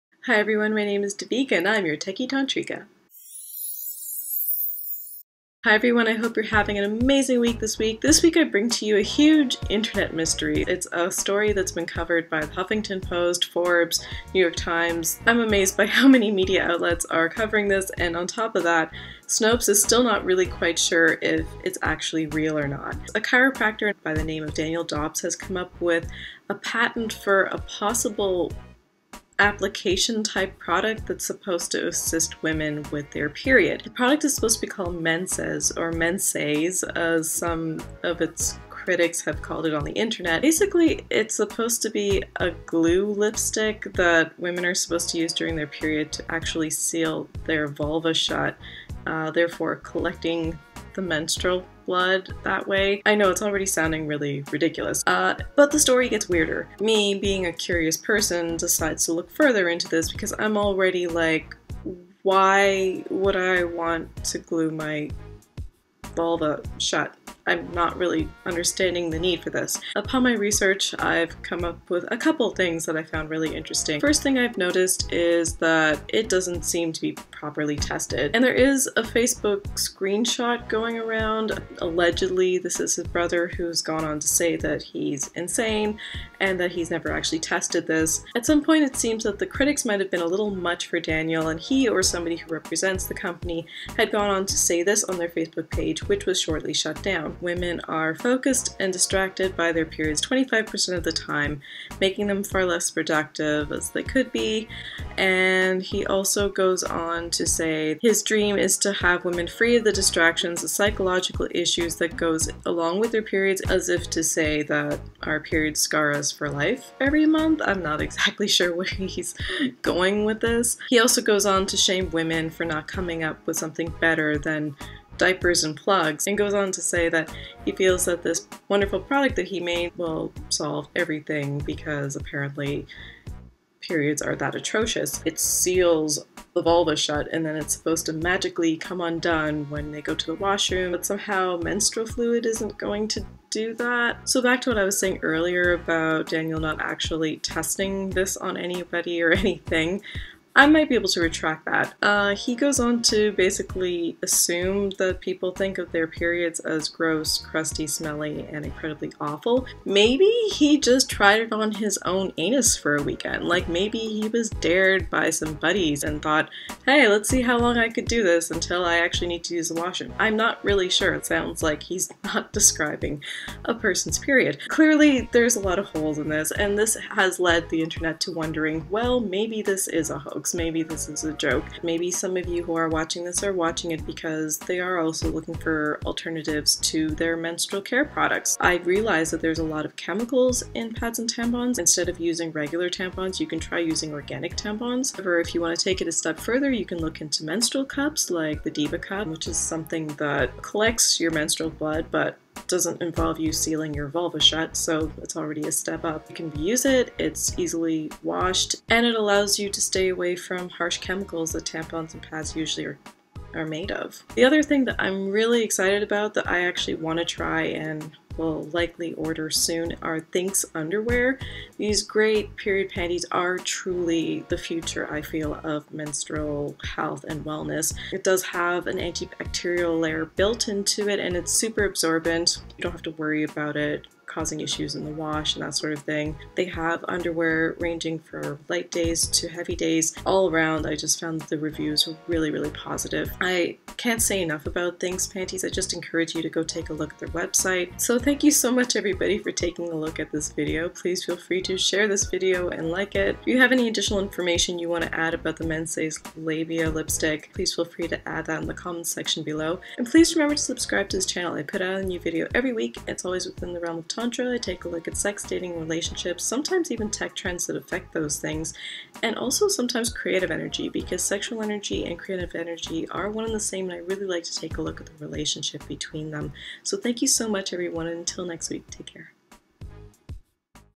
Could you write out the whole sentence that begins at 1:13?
First thing I've noticed is that it doesn't seem to be properly tested.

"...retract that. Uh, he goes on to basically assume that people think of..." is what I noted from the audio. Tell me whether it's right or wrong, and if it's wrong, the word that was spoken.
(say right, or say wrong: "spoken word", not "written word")
right.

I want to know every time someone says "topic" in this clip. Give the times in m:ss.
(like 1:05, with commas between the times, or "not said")
not said.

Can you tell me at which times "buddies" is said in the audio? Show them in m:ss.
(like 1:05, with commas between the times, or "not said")
2:45.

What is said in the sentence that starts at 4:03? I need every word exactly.
I can't say enough about THINX Panties.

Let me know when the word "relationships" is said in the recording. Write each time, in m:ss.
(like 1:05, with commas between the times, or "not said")
4:25, 4:35.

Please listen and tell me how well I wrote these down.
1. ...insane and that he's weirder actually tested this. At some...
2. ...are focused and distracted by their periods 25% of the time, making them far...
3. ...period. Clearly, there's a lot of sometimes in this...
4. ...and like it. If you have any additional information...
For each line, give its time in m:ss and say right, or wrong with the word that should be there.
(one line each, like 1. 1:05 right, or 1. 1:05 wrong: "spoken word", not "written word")
1. 1:25 wrong: "never", not "weirder"
2. 1:37 right
3. 2:54 wrong: "holes", not "sometimes"
4. 4:12 right.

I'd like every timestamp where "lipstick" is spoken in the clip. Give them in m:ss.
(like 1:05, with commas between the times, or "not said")
0:43, 4:16.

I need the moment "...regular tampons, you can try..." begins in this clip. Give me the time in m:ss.
3:12.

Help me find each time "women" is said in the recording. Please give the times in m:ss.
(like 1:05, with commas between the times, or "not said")
0:32, 0:44, 1:37, 1:49, 2:02.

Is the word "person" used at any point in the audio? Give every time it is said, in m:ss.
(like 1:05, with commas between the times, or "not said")
0:57, 2:53.